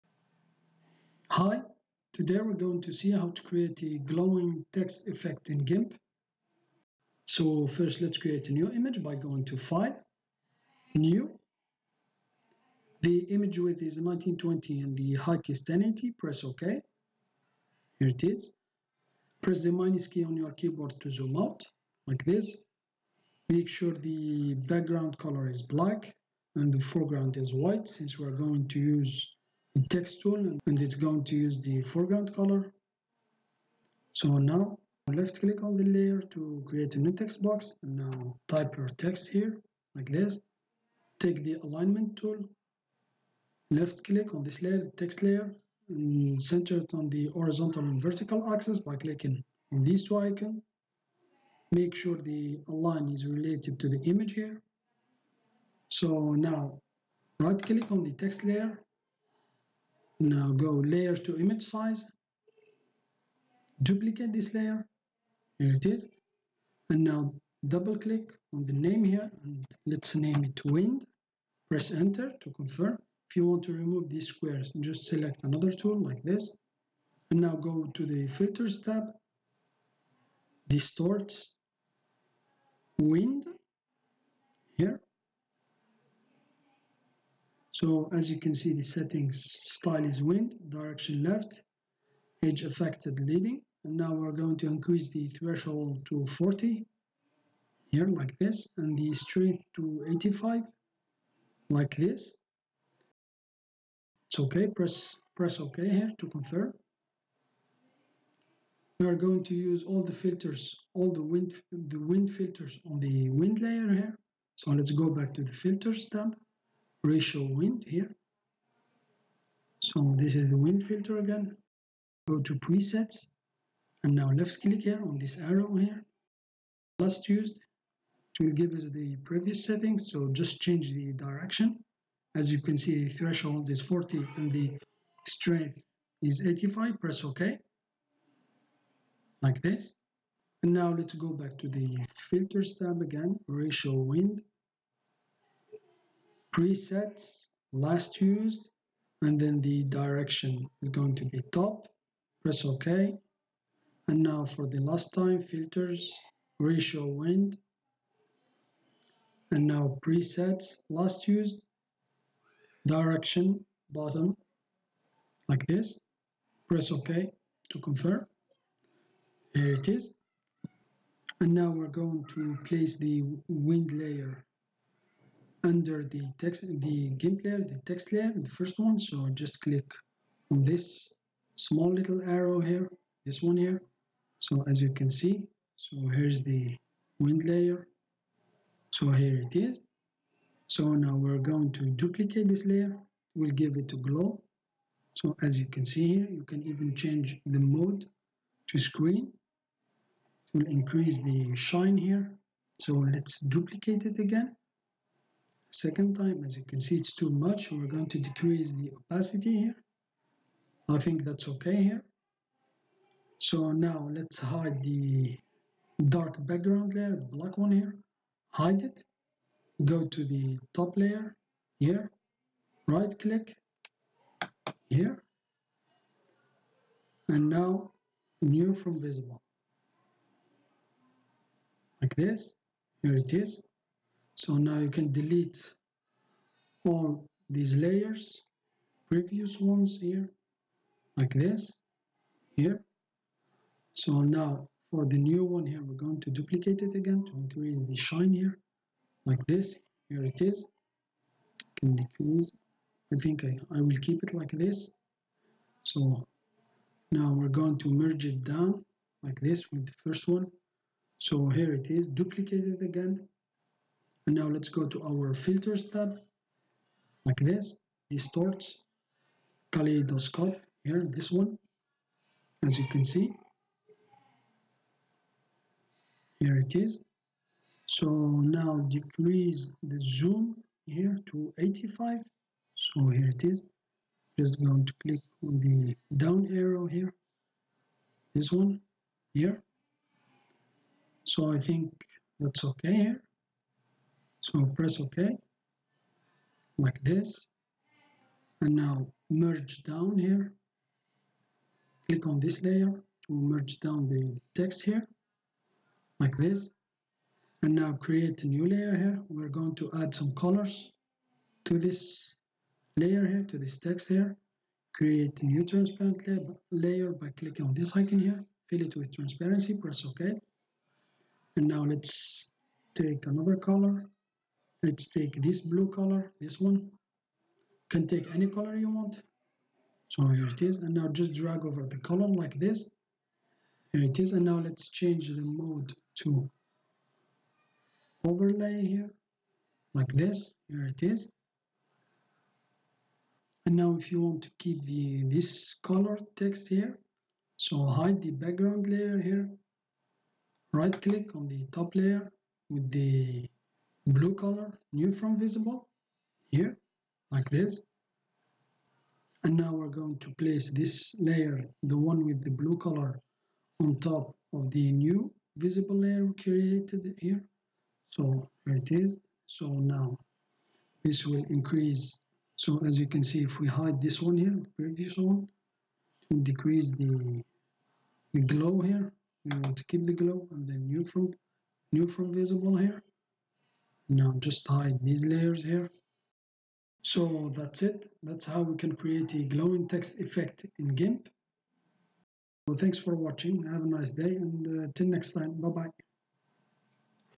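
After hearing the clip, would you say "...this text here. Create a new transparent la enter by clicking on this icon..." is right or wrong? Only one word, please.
wrong.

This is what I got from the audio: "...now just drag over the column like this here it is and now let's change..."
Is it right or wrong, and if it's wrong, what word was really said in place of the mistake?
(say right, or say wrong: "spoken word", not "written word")
right.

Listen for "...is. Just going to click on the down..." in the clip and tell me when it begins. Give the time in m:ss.
4:43.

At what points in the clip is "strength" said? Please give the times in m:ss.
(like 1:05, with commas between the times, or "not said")
1:39, 2:15.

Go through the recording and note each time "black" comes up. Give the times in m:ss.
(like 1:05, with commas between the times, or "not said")
0:25, 3:37.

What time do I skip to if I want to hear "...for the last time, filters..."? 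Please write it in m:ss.
2:34.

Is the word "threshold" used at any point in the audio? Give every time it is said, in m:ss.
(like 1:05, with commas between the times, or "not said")
1:35, 2:13.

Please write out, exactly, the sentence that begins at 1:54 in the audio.
So let's go back to the filters tab re-show wind here.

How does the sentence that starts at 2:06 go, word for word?
Last used, to give us the previous settings.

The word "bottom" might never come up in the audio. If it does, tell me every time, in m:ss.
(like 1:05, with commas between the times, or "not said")
2:43.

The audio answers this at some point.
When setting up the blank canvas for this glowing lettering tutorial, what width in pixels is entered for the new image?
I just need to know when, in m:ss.
0:14.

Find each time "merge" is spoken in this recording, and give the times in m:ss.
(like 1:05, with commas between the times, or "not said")
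4:17, 4:59, 5:03.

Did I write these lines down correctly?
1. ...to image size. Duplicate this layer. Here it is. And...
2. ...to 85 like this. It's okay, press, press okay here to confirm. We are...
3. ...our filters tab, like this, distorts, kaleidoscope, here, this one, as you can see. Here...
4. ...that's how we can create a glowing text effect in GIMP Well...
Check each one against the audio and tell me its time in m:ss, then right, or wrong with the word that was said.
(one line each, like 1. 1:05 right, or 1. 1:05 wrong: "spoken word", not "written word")
1. 1:01 right
2. 1:39 right
3. 4:25 right
4. 6:28 right.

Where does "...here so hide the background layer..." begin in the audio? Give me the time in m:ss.
5:46.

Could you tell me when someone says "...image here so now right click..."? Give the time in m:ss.
0:54.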